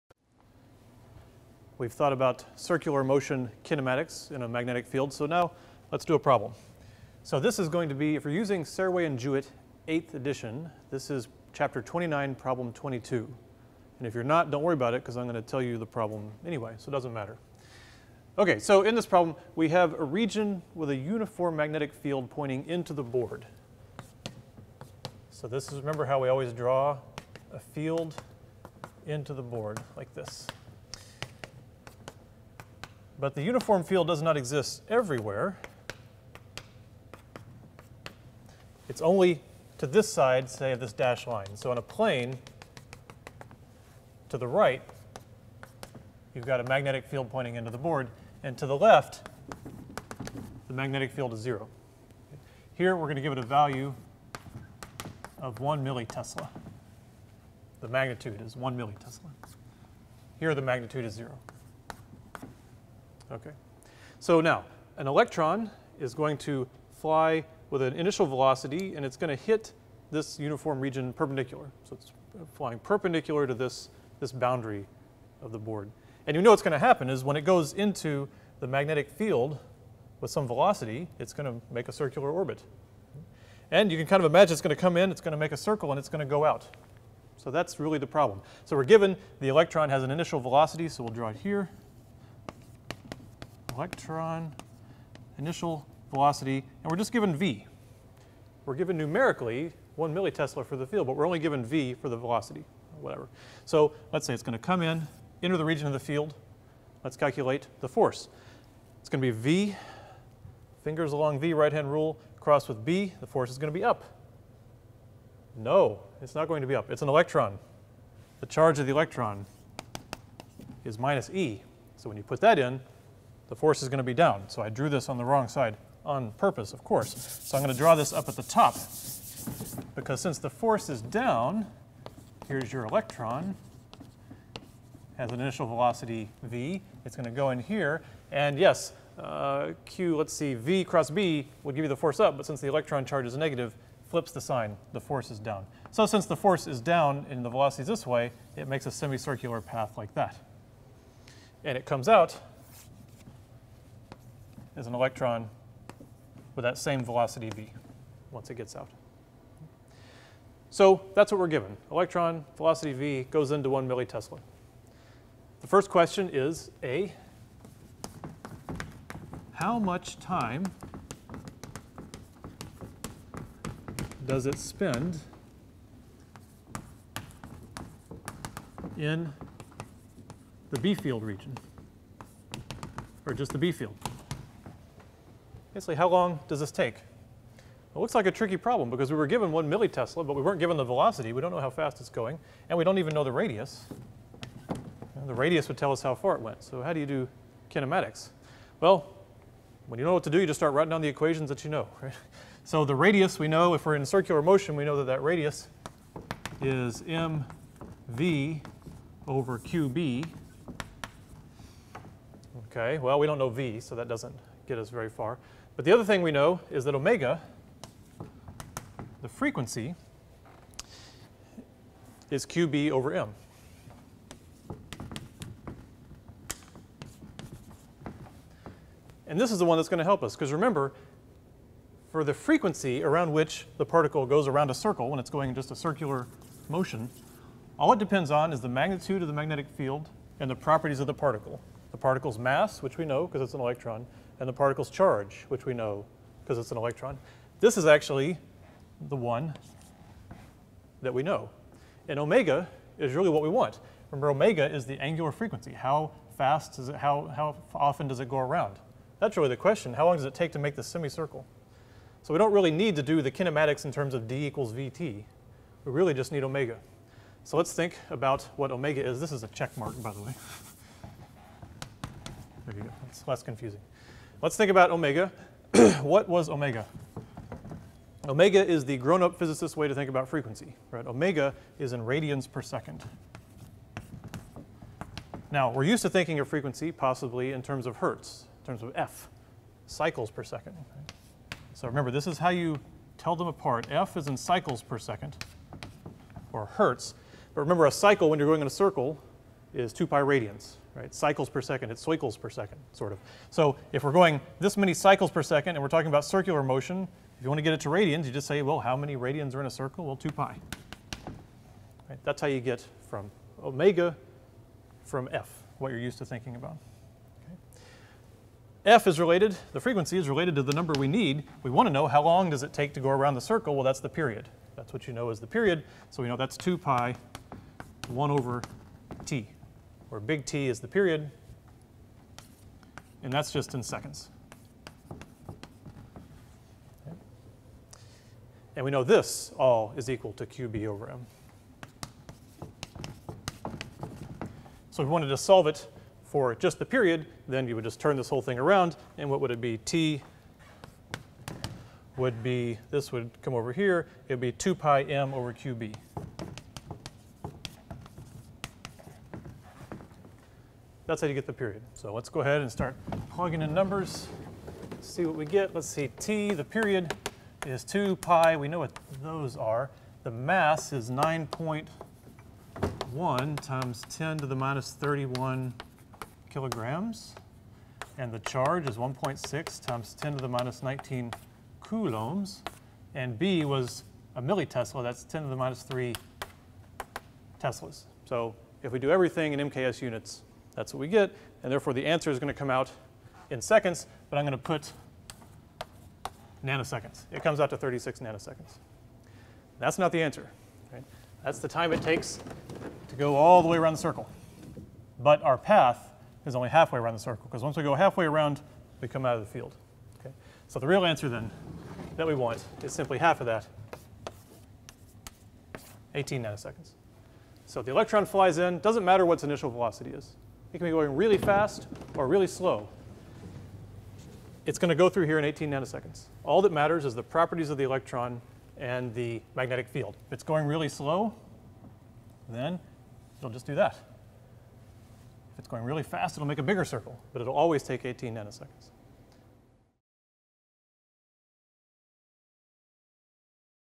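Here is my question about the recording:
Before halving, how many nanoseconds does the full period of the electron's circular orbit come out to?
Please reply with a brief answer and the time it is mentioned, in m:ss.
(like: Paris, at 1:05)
36 nanoseconds, at 6:37.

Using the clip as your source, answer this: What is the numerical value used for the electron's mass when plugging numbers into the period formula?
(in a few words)
9.1 x 10^-31 kg.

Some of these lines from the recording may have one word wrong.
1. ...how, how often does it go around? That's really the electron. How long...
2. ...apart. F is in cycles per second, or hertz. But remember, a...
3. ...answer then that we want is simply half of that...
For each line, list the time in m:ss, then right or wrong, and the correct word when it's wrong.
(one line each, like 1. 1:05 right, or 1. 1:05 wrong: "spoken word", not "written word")
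1. 4:16 wrong: "question", not "electron"
2. 4:53 right
3. 6:51 right.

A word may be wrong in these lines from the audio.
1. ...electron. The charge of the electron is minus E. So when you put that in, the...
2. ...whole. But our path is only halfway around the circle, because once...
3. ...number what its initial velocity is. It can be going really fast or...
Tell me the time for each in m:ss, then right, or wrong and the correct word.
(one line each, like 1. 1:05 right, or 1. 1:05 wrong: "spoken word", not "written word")
1. 1:57 right
2. 6:43 wrong: "circle", not "whole"
3. 6:59 wrong: "matter", not "number".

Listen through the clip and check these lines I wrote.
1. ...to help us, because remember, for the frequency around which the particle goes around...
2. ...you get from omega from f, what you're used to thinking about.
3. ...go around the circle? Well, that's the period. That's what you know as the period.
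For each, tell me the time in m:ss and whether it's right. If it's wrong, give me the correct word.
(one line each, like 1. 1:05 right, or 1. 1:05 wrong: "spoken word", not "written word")
1. 3:49 right
2. 5:12 right
3. 5:22 right.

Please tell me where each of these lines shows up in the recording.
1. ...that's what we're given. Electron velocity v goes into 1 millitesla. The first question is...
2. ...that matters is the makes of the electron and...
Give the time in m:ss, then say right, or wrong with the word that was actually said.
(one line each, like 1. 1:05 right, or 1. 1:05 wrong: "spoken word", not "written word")
1. 2:41 right
2. 7:06 wrong: "properties", not "makes".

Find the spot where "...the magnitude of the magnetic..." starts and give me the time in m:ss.
3:58.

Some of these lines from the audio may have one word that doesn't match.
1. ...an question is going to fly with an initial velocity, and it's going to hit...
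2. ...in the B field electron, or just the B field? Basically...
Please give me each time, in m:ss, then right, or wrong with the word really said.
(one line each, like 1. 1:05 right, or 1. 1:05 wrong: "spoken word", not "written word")
1. 1:04 wrong: "electron", not "question"
2. 2:58 wrong: "region", not "electron".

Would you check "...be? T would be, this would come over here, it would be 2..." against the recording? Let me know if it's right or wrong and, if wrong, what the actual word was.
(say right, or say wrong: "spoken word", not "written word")
right.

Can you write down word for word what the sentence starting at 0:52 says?
Here, we're going to give it a value of 1 millitesla.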